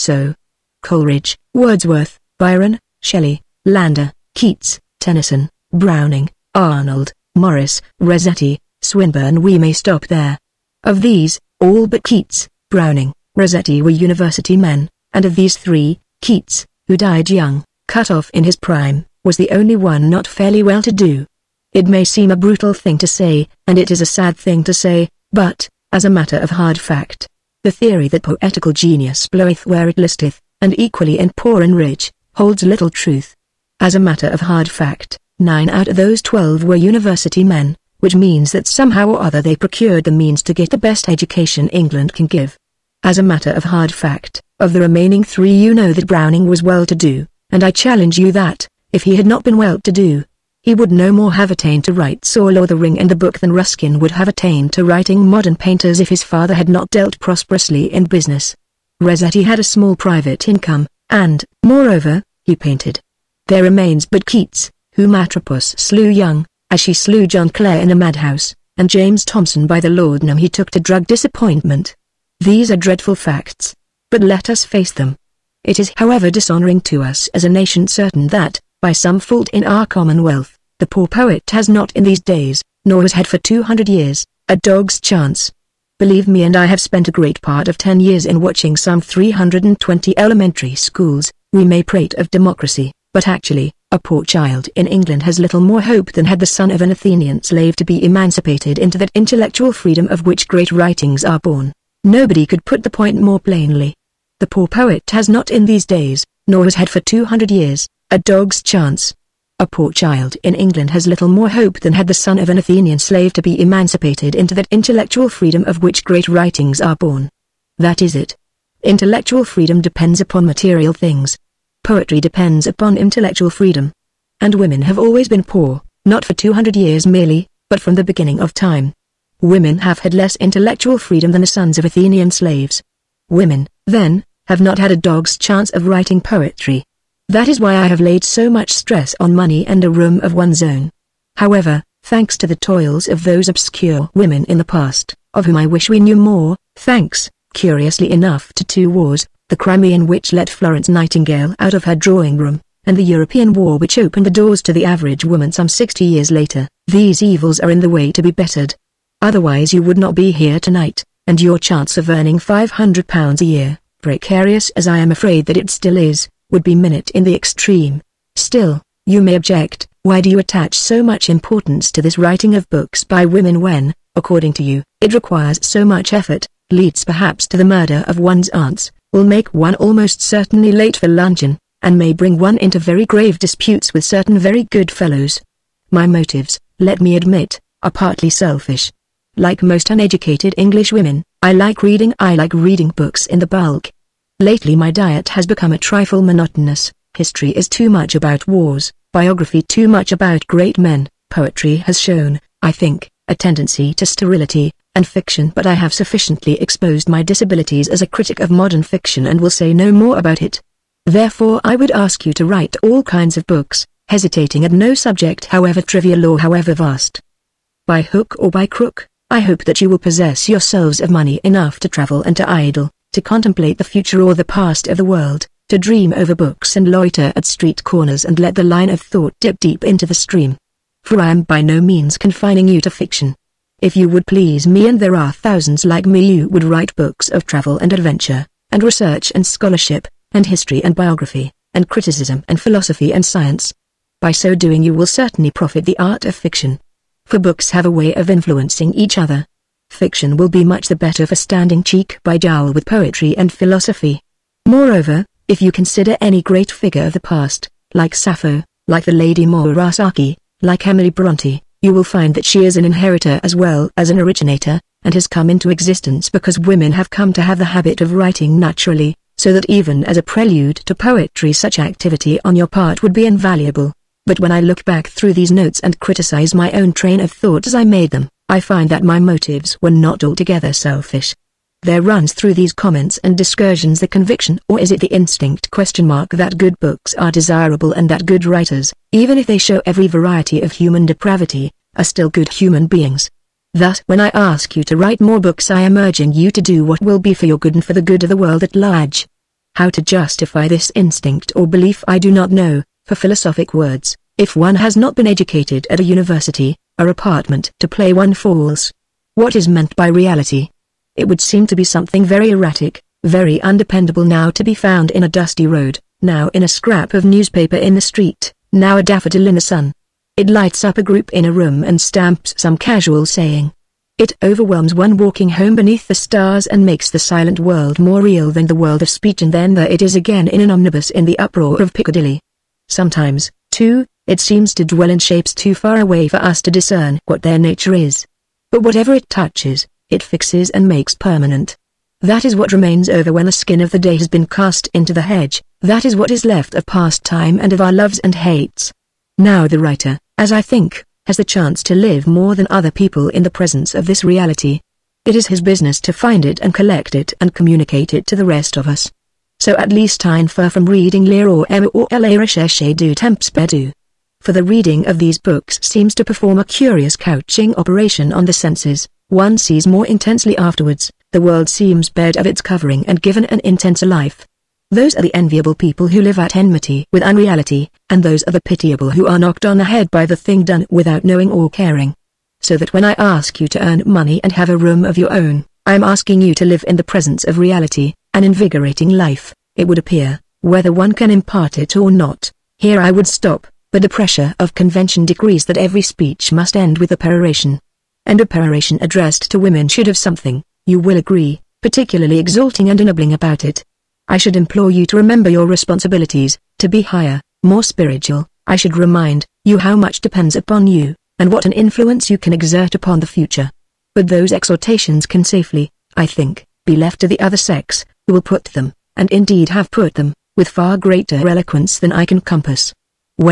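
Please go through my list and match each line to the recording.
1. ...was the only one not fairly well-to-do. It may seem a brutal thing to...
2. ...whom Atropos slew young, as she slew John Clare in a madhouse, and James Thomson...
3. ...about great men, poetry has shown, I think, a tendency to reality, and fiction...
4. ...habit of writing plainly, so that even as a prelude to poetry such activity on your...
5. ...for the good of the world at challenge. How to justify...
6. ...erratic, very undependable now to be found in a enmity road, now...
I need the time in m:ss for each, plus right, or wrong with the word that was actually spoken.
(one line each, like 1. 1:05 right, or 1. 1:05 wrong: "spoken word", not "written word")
1. 0:19 right
2. 1:04 right
3. 3:20 wrong: "sterility", not "reality"
4. 4:27 wrong: "naturally", not "plainly"
5. 4:57 wrong: "large", not "challenge"
6. 5:12 wrong: "dusty", not "enmity".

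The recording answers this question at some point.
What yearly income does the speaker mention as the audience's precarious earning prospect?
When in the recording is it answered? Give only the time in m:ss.
2:42.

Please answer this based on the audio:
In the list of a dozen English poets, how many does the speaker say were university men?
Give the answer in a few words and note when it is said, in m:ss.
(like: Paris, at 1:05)
9, at 0:35.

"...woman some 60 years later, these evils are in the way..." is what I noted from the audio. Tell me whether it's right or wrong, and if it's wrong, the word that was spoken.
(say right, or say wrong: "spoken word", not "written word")
right.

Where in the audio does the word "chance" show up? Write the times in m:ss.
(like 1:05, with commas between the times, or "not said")
1:24, 1:48, 2:15, 2:41, 5:51.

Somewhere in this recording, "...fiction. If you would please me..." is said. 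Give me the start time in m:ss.
3:52.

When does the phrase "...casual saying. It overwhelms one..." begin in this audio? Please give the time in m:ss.
5:22.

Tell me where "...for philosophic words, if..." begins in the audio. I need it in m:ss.
5:03.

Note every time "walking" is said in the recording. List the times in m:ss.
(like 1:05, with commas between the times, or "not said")
5:25.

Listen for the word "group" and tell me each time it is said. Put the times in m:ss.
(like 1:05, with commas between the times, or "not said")
5:21.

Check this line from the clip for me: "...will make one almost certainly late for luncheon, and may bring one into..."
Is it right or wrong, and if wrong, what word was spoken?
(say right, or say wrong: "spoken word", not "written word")
right.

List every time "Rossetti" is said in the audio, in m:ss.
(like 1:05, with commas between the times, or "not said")
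0:07, 0:13, 0:58.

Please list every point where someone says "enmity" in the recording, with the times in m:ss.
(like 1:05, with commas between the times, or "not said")
6:16.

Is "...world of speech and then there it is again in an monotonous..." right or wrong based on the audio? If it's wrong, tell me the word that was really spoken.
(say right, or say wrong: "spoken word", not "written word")
wrong: "omnibus", not "monotonous".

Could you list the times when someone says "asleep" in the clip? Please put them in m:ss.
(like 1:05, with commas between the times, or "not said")
not said.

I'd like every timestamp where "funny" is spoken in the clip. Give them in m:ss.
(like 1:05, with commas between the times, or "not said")
not said.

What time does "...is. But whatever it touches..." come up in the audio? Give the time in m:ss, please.
5:37.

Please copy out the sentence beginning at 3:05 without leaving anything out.
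My motives, let me admit, are partly selfish.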